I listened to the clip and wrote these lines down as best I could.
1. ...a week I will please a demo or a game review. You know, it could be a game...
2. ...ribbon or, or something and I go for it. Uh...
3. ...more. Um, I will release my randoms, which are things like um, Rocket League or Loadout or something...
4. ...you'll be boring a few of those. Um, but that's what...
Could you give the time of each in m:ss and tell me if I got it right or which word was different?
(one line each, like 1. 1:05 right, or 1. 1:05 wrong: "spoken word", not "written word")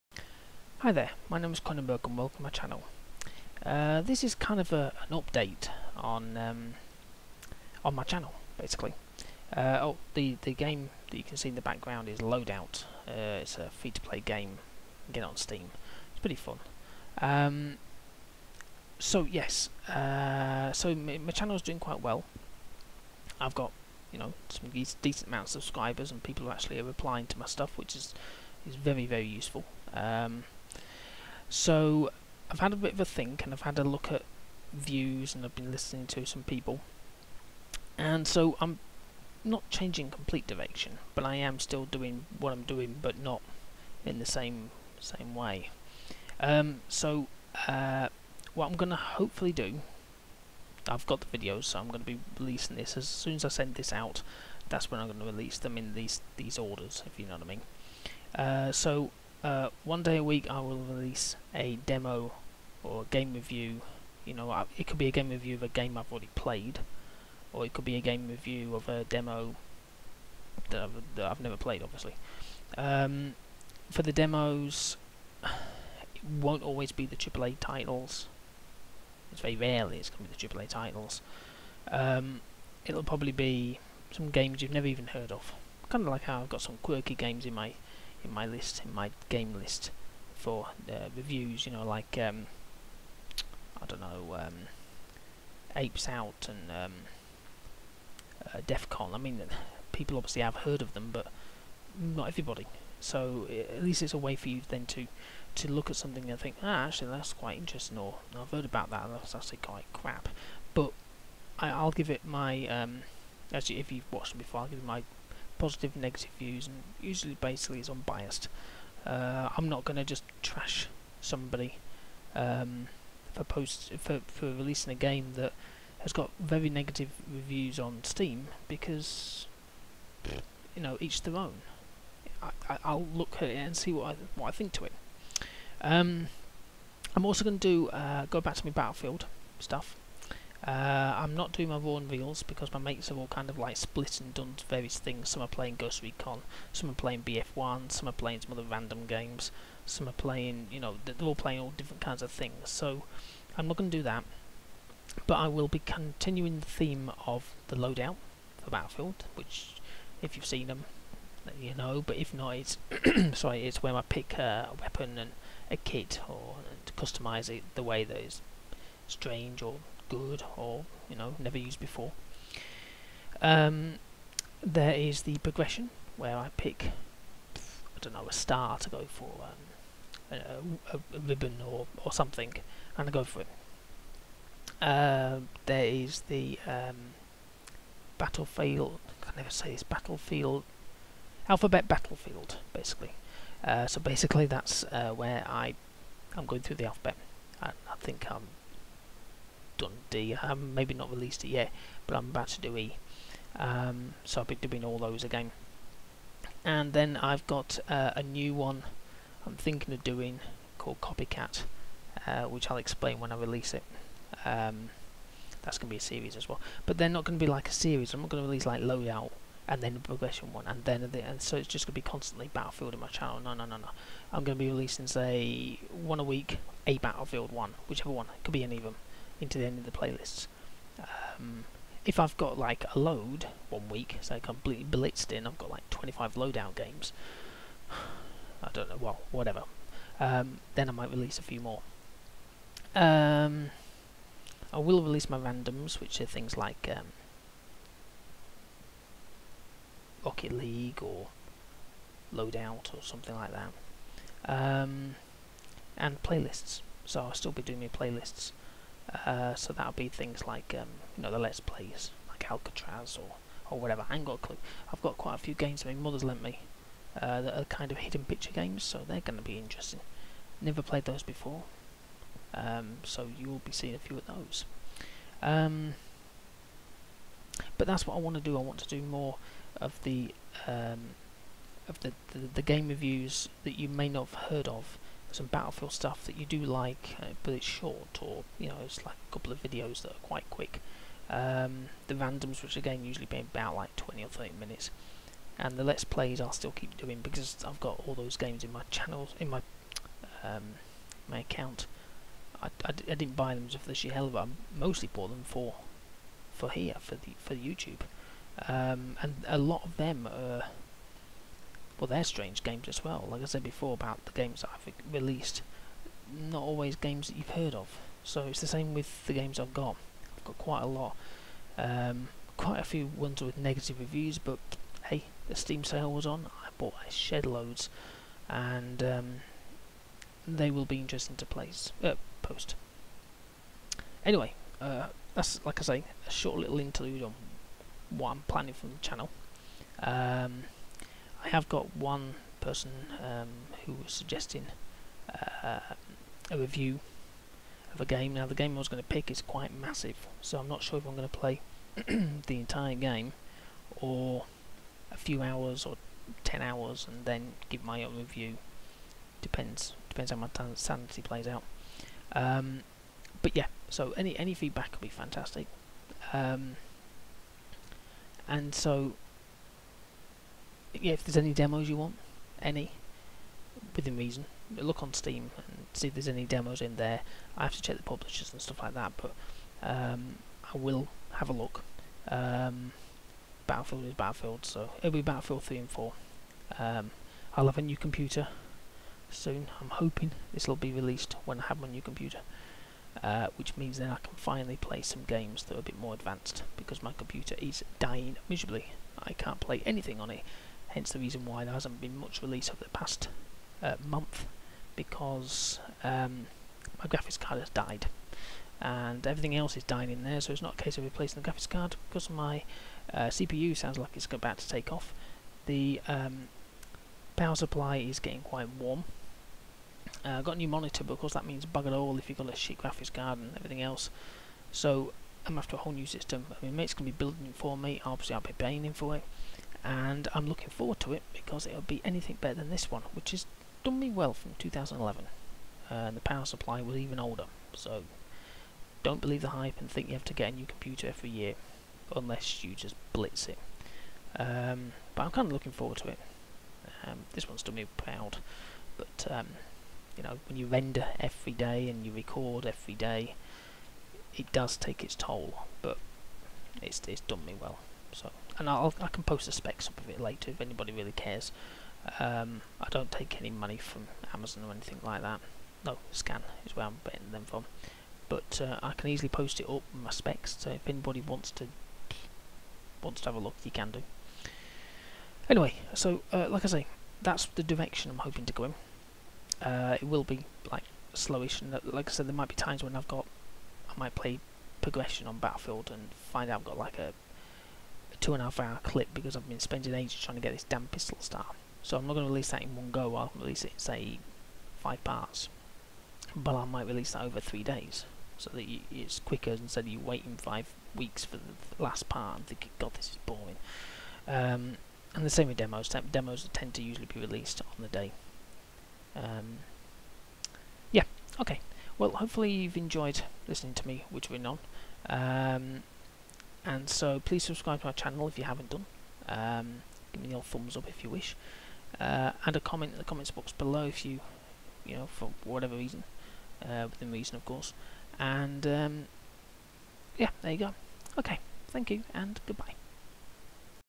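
1. 1:00 wrong: "release", not "please"
2. 3:01 right
3. 4:01 right
4. 4:33 wrong: "seeing", not "boring".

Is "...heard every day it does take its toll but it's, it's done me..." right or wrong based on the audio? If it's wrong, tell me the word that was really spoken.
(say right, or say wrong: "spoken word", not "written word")
wrong: "record", not "heard".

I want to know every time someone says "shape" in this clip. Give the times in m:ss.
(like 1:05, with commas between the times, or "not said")
not said.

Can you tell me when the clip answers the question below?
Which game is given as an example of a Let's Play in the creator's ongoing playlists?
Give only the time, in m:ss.
4:22.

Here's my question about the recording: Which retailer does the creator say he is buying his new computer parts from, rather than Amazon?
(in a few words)
Scan.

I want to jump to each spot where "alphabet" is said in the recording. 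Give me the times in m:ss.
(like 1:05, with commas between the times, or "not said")
3:11, 3:16.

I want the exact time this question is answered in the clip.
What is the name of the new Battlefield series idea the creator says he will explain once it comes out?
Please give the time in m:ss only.
3:31.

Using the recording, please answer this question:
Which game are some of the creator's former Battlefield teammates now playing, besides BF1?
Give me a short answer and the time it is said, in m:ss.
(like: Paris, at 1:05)
Ghost Recon, at 2:25.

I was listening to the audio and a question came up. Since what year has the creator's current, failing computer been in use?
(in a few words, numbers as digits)
2011.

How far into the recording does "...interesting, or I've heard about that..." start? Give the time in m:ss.
1:47.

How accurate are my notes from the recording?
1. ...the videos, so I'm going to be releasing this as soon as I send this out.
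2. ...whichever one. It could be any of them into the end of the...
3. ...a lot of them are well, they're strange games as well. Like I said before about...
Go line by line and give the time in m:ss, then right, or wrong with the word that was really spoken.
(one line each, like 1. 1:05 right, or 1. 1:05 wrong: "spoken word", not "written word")
1. 0:51 right
2. 3:47 right
3. 5:09 right.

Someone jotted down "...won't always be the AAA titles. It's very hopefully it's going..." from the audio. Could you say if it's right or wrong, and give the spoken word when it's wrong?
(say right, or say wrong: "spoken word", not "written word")
wrong: "rarely", not "hopefully".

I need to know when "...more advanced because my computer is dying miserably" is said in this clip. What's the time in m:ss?
6:35.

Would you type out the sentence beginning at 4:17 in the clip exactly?
So I'll still be doing my playlists.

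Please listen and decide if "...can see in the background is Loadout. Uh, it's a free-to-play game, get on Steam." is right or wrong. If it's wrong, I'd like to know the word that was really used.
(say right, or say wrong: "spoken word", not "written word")
right.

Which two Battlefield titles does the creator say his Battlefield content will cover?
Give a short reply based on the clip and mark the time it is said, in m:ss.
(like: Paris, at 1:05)
Battlefield 3 and 4, at 6:25.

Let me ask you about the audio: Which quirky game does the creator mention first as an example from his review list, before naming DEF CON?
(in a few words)
Apes Out.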